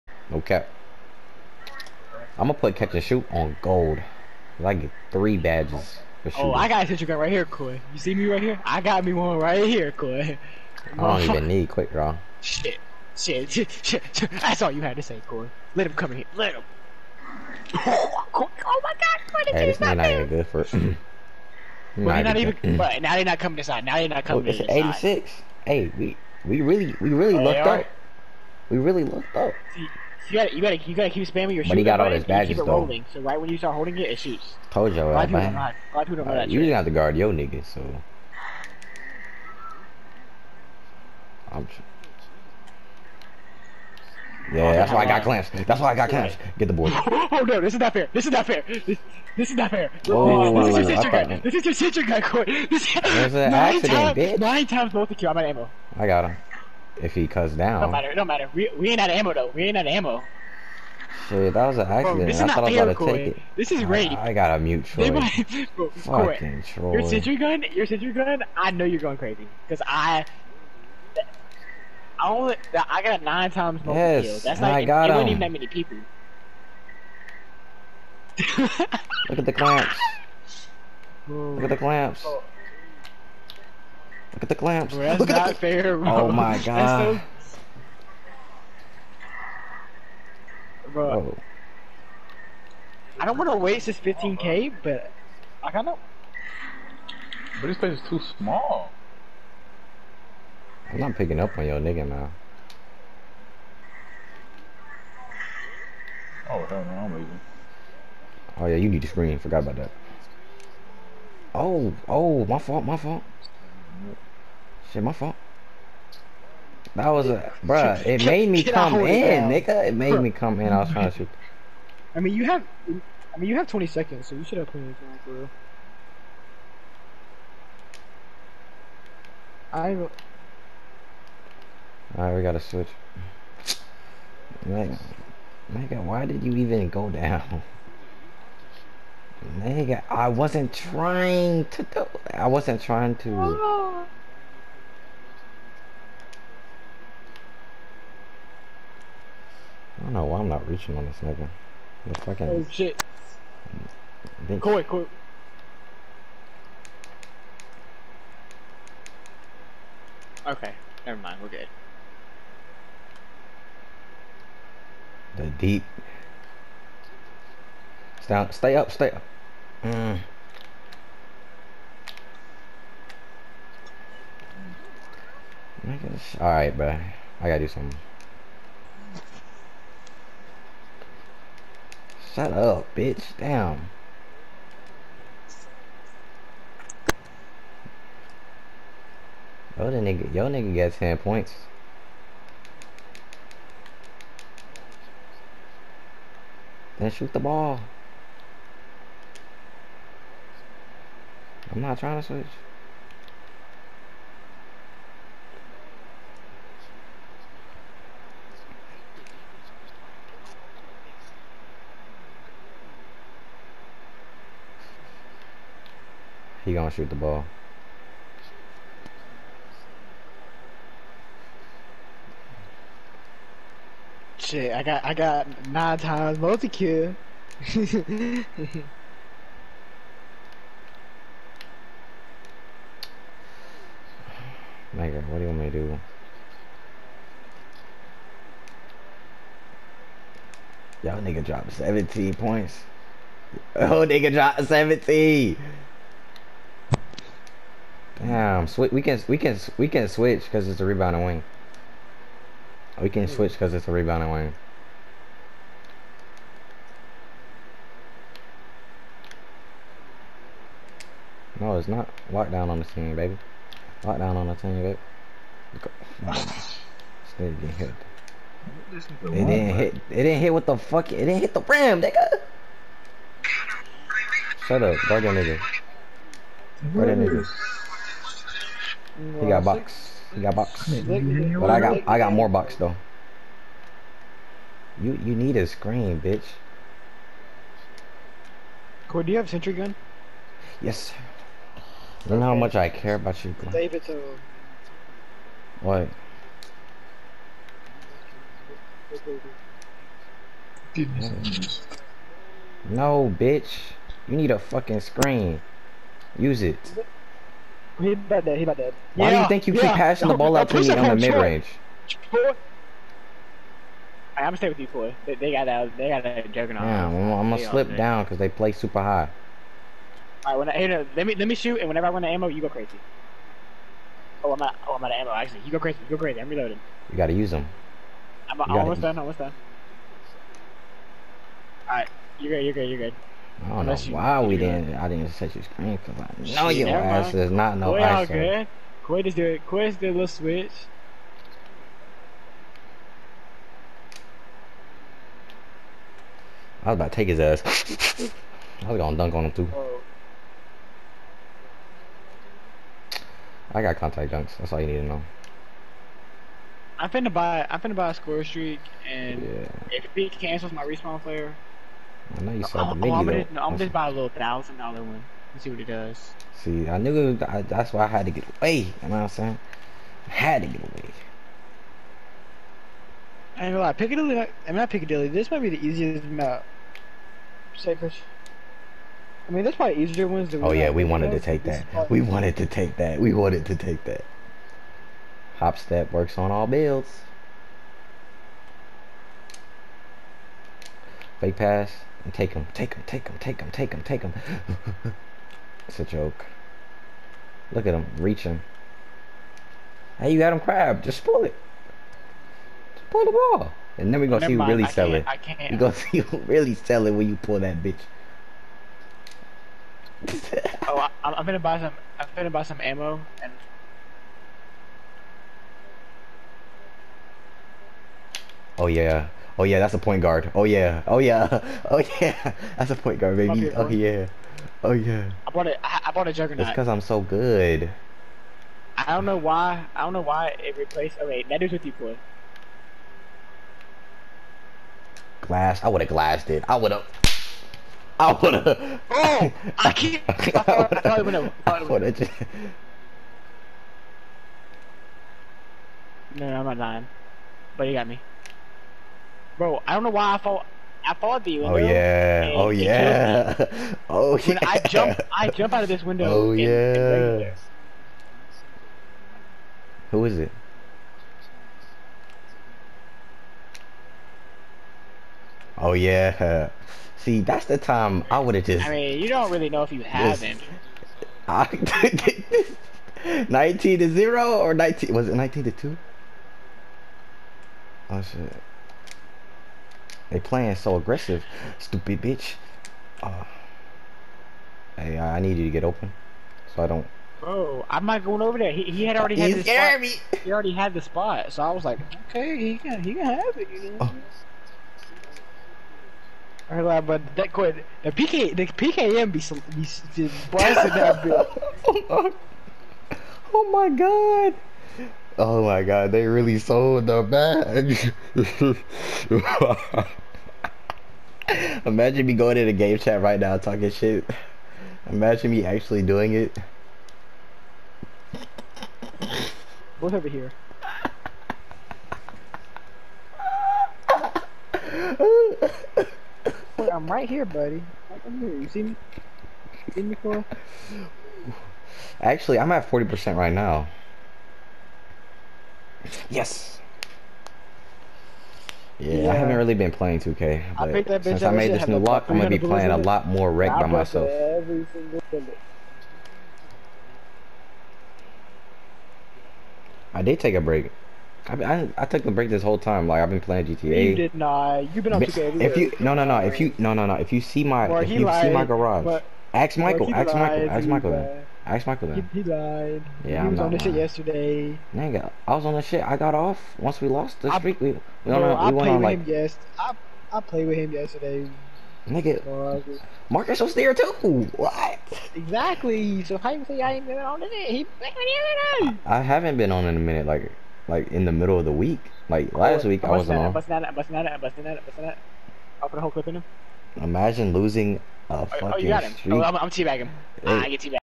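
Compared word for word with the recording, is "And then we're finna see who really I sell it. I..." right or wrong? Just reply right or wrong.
wrong.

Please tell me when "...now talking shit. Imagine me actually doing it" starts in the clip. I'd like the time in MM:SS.
08:33.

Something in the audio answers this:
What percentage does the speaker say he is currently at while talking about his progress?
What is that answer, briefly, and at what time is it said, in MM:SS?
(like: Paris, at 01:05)
40%, at 08:52.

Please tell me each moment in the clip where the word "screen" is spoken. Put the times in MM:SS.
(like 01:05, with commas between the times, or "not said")
01:49, 04:22, 04:45, 05:04, 05:35.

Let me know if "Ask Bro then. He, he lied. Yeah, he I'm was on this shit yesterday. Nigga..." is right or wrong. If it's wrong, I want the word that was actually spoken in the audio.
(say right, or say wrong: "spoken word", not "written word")
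wrong: "Michael", not "Bro".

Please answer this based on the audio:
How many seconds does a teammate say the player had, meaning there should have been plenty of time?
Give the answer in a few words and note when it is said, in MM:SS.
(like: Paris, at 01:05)
20, at 02:03.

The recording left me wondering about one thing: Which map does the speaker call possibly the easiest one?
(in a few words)
Sacred.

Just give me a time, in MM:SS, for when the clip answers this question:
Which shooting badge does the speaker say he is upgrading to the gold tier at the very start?
00:02.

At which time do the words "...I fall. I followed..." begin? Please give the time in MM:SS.
07:30.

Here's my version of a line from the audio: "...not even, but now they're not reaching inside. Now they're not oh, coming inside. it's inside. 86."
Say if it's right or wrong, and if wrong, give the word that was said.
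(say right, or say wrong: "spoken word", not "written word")
wrong: "coming", not "reaching".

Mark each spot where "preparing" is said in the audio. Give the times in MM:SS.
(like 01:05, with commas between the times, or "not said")
not said.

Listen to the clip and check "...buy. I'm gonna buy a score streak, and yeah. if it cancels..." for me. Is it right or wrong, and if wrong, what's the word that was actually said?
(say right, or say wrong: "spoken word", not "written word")
wrong: "finna", not "gonna".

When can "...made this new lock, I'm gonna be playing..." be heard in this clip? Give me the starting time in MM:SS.
09:01.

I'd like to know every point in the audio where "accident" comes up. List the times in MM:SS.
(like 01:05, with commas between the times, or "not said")
00:53, 01:01.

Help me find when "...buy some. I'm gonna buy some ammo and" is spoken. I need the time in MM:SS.
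06:51.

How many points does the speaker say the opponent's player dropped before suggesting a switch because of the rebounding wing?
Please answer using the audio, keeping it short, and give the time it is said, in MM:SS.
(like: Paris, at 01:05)
17, at 04:01.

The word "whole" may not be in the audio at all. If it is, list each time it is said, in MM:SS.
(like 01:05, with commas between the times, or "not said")
09:12, 09:46.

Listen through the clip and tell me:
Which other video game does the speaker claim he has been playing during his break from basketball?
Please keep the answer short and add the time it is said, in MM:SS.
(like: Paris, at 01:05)
GTA, at 09:13.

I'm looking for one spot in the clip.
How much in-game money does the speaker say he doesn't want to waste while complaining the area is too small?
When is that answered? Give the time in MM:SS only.
01:33.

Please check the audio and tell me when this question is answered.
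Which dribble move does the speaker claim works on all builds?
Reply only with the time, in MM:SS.
06:25.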